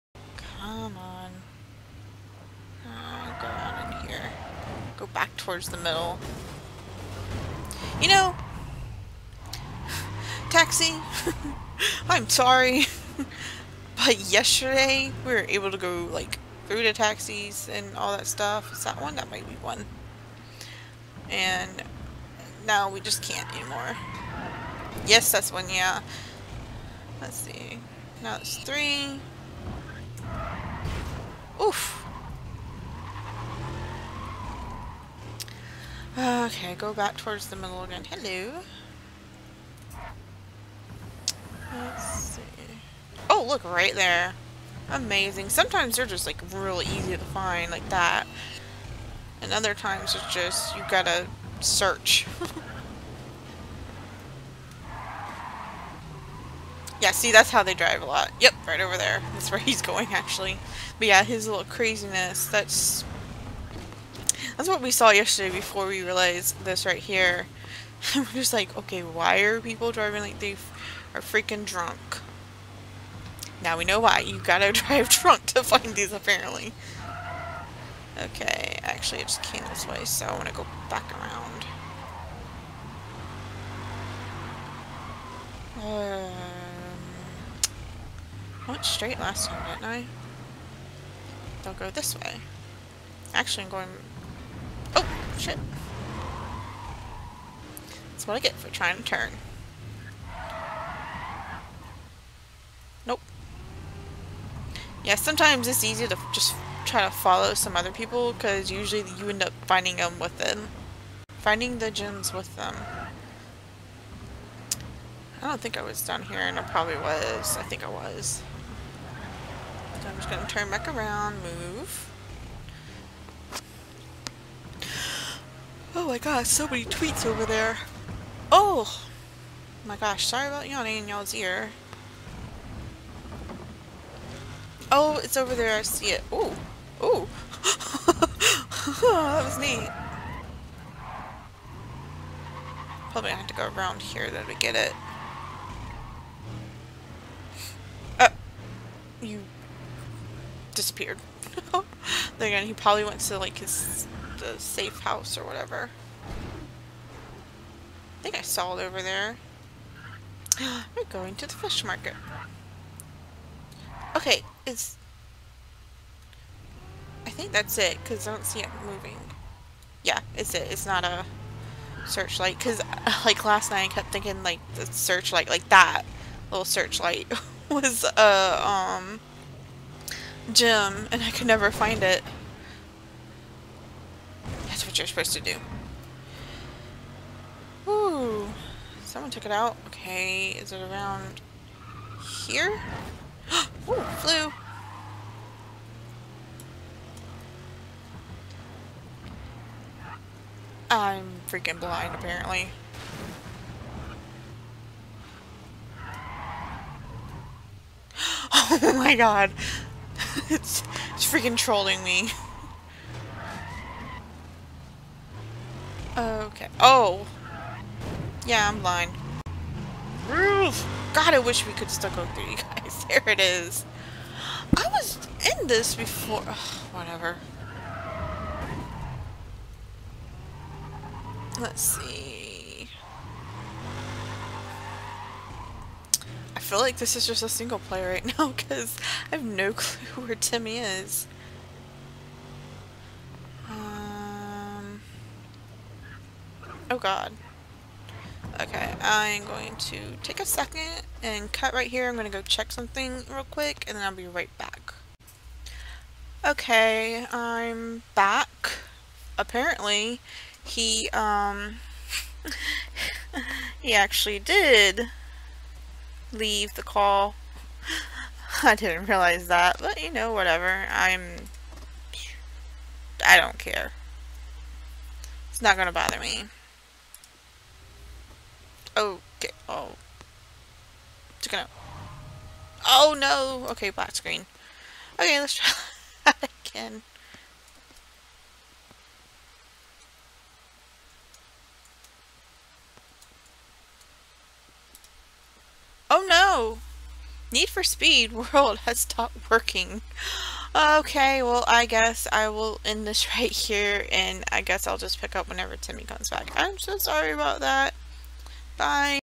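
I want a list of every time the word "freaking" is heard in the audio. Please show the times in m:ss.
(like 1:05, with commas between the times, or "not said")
1:11, 3:21, 3:31.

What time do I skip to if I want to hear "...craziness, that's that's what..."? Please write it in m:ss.
1:01.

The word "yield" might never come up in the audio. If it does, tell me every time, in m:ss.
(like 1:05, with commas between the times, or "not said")
not said.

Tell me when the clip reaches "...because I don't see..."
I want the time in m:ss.
2:48.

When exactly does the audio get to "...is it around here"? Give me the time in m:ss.
3:10.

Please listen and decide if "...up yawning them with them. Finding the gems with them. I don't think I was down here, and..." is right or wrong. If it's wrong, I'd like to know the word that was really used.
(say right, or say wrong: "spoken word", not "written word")
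wrong: "finding", not "yawning".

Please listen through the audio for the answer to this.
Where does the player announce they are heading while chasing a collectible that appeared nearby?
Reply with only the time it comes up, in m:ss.
2:41.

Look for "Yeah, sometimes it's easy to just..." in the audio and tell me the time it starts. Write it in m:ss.
1:45.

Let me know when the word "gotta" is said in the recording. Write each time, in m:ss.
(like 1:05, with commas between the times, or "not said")
0:50, 1:14.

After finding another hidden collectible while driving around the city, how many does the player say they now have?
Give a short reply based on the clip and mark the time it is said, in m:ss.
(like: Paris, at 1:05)
3, at 0:28.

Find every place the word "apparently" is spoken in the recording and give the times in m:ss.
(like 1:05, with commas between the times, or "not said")
1:16, 3:22, 4:19.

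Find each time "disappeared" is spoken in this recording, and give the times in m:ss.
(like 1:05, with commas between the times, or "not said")
2:30.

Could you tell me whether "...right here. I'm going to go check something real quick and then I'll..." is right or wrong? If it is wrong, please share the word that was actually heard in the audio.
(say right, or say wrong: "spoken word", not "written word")
right.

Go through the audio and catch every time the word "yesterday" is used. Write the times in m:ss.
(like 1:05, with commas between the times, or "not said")
0:14, 1:05.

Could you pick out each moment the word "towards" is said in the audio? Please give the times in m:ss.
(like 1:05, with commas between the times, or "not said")
0:05, 0:37.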